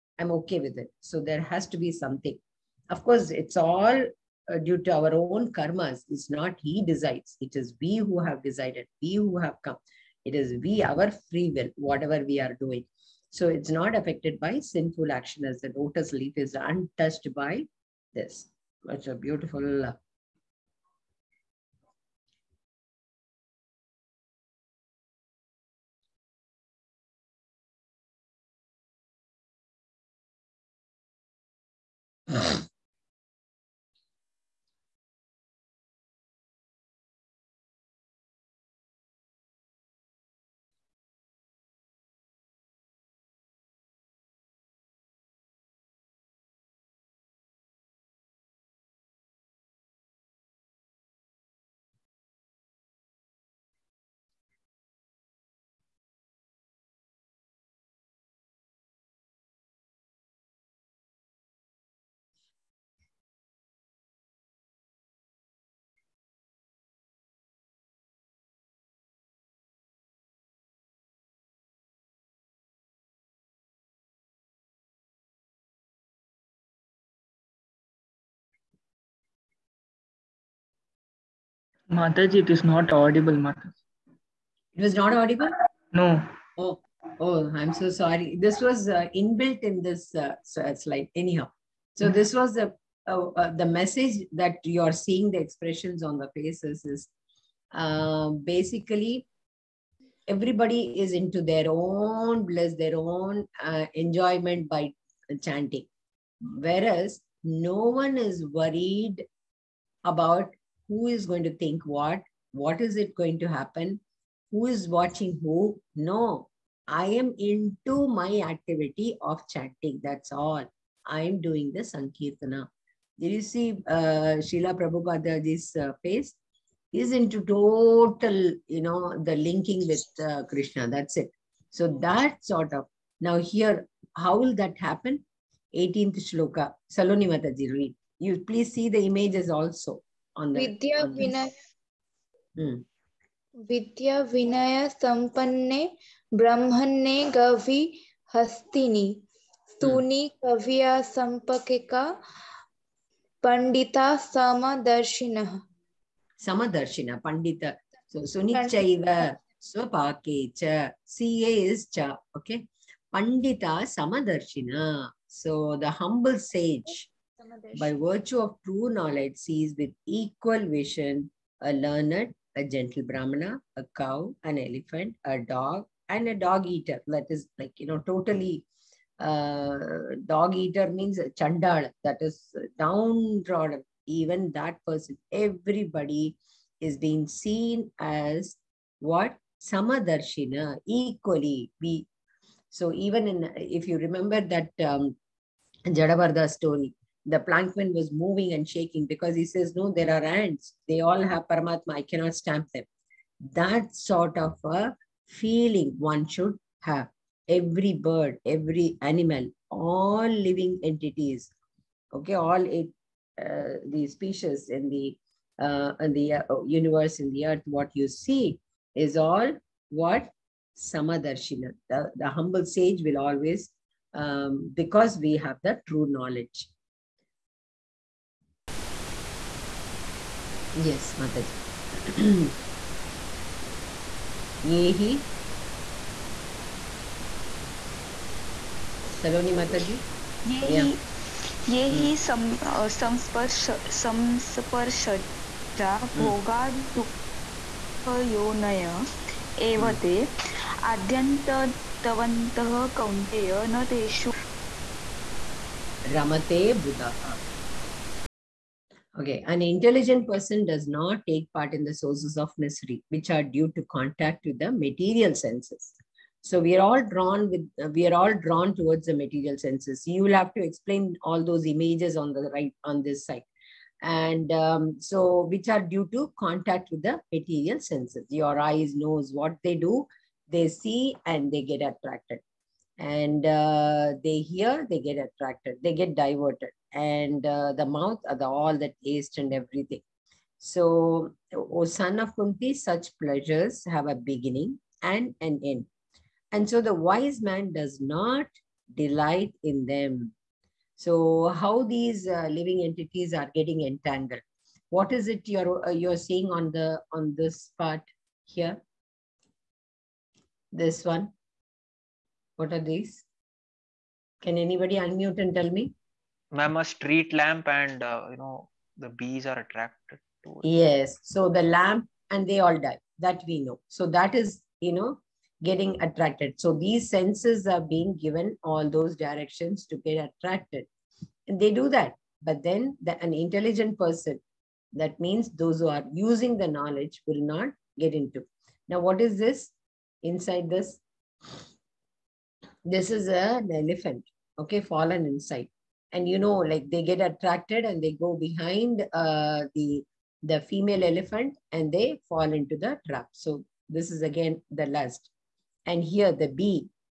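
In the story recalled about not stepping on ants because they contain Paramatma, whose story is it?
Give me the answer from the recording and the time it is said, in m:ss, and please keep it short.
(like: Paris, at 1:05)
Jada Bharata, at 3:15.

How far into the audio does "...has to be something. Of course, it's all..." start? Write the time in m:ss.
0:01.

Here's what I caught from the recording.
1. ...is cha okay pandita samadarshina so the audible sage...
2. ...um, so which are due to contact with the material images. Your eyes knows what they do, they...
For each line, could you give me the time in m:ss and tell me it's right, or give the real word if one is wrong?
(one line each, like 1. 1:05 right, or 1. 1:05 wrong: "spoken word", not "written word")
1. 2:41 wrong: "humble", not "audible"
2. 4:34 wrong: "senses", not "images".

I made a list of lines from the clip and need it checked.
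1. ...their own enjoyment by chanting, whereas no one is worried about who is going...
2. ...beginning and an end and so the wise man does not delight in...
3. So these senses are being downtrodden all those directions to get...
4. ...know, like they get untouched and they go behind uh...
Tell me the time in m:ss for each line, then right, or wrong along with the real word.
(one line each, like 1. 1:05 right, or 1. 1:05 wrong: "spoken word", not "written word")
1. 1:42 right
2. 4:54 right
3. 5:26 wrong: "given", not "downtrodden"
4. 5:46 wrong: "attracted", not "untouched".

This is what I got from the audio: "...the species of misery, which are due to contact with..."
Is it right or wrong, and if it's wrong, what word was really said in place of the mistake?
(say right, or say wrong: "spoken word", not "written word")
wrong: "sources", not "species".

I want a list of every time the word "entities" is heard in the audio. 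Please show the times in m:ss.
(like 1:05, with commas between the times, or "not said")
3:30, 5:02.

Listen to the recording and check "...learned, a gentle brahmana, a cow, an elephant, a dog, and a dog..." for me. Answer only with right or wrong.
right.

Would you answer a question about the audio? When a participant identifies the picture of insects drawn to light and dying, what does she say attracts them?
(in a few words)
a street lamp.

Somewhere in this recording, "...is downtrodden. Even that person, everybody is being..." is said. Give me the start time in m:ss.
3:02.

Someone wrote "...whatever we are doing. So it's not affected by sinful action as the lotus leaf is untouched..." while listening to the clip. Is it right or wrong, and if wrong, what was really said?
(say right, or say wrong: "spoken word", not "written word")
right.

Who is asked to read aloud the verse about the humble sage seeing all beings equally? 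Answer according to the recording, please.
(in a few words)
Saloni Mataji.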